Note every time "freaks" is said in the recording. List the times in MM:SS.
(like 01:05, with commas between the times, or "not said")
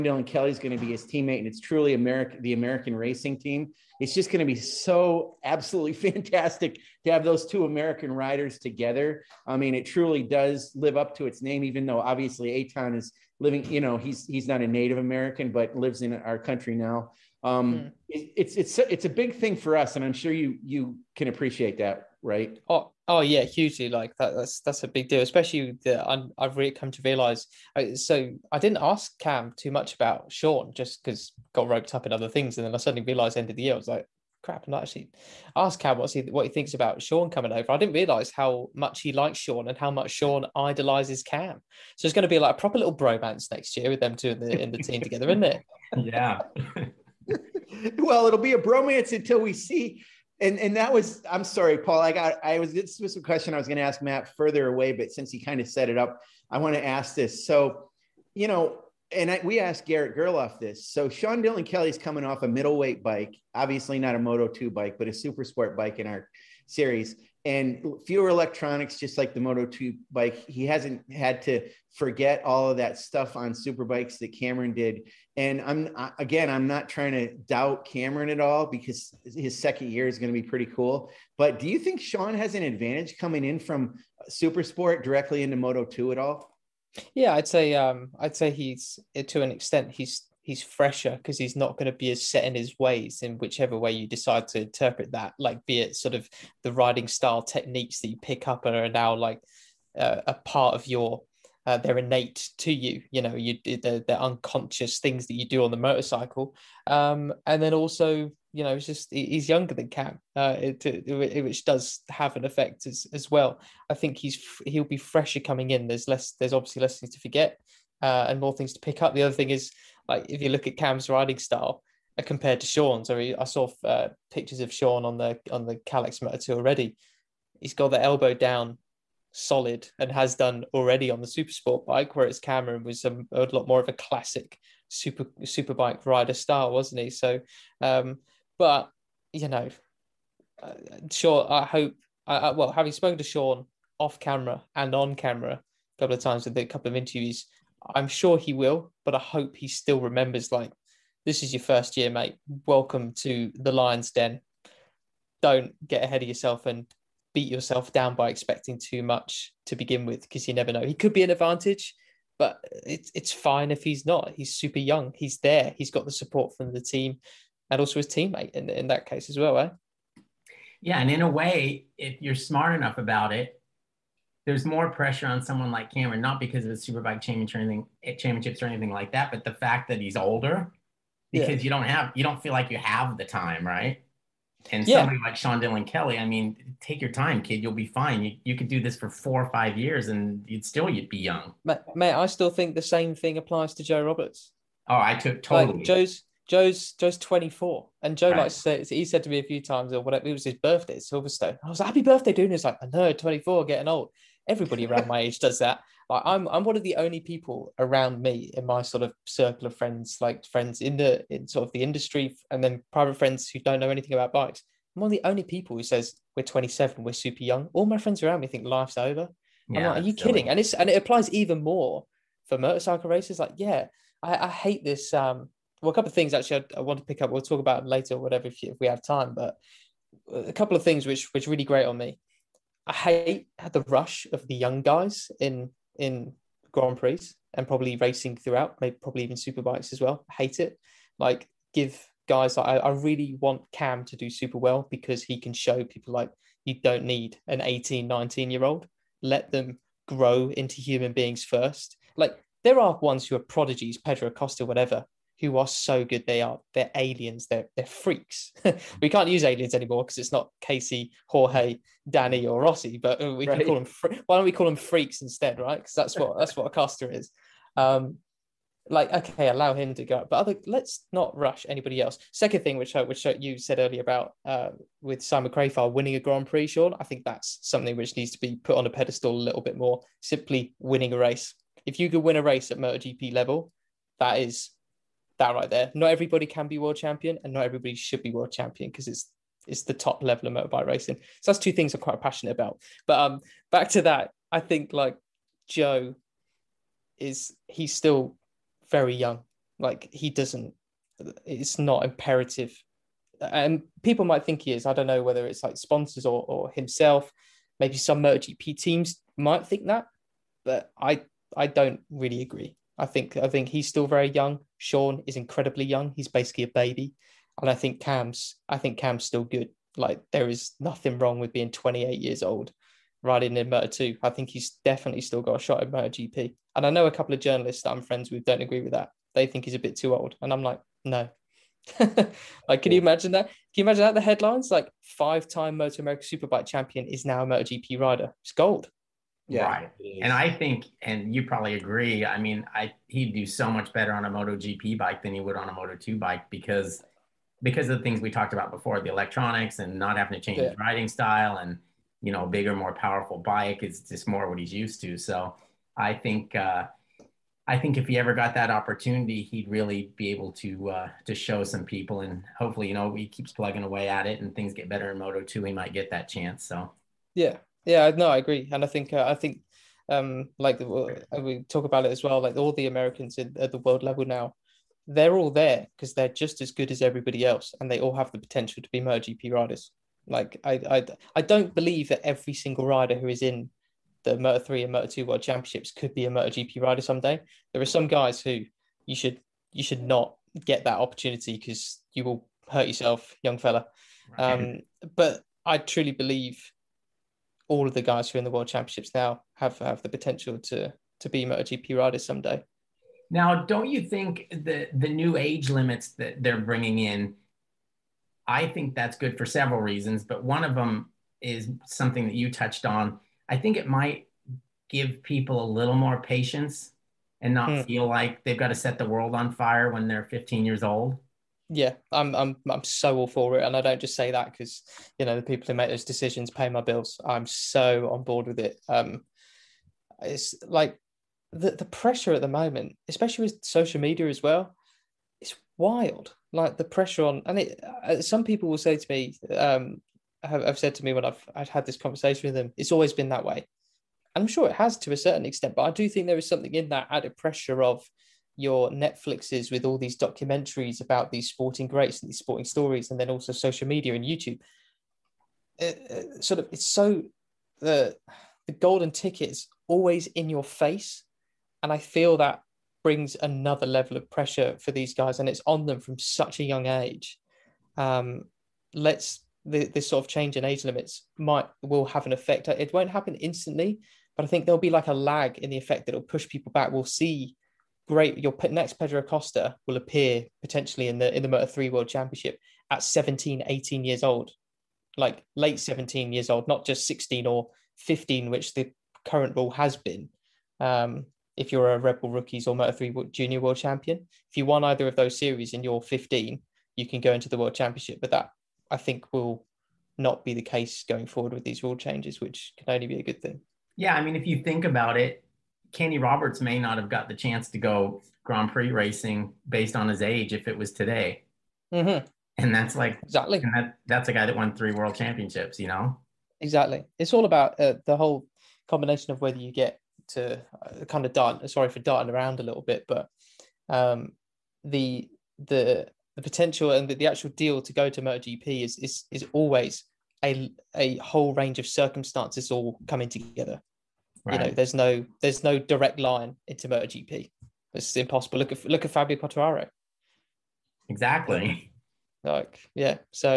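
04:17, 04:24.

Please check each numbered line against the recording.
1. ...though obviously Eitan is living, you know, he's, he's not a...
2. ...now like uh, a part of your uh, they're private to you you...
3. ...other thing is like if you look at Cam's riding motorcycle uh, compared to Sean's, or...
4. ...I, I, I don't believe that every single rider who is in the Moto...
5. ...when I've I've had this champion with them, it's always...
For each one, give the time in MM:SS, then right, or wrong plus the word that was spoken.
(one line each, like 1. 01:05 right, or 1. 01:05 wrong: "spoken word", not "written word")
1. 00:11 right
2. 01:38 wrong: "innate", not "private"
3. 01:59 wrong: "style", not "motorcycle"
4. 06:20 right
5. 07:21 wrong: "conversation", not "champion".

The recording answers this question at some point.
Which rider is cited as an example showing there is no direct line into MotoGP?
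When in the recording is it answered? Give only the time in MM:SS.
08:59.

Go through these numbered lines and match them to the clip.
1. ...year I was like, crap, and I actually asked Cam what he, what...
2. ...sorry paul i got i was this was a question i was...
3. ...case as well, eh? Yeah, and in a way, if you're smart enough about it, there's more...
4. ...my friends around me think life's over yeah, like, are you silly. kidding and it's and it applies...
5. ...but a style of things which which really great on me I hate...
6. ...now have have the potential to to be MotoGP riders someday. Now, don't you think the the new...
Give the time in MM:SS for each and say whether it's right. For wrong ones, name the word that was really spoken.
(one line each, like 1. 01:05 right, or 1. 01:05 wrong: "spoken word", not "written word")
1. 00:33 right
2. 00:51 right
3. 02:49 right
4. 03:37 right
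5. 03:49 wrong: "couple", not "style"
6. 06:39 right.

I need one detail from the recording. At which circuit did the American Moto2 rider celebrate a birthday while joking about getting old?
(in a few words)
Silverstone.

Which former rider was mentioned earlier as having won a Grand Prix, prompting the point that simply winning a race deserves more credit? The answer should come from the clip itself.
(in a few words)
Simon Crafar.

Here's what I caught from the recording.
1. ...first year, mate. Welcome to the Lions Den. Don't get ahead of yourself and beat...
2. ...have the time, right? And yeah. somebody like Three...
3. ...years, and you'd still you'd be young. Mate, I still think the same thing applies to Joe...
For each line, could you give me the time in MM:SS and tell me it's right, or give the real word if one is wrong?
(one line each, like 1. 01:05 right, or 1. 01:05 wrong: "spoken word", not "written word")
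1. 02:31 right
2. 03:02 wrong: "Sean", not "Three"
3. 03:09 right.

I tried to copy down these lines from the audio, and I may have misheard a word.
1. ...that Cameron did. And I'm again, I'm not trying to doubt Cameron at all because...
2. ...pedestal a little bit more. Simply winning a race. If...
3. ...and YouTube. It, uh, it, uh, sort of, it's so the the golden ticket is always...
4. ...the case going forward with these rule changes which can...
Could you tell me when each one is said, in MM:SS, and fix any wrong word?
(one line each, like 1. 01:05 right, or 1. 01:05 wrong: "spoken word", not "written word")
1. 01:14 right
2. 04:38 right
3. 07:34 right
4. 08:20 right.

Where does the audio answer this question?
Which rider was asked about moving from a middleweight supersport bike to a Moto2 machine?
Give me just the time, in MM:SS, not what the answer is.
00:59.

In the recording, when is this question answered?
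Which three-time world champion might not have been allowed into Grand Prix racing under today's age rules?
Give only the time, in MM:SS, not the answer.
08:25.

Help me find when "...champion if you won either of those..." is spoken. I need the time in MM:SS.
08:13.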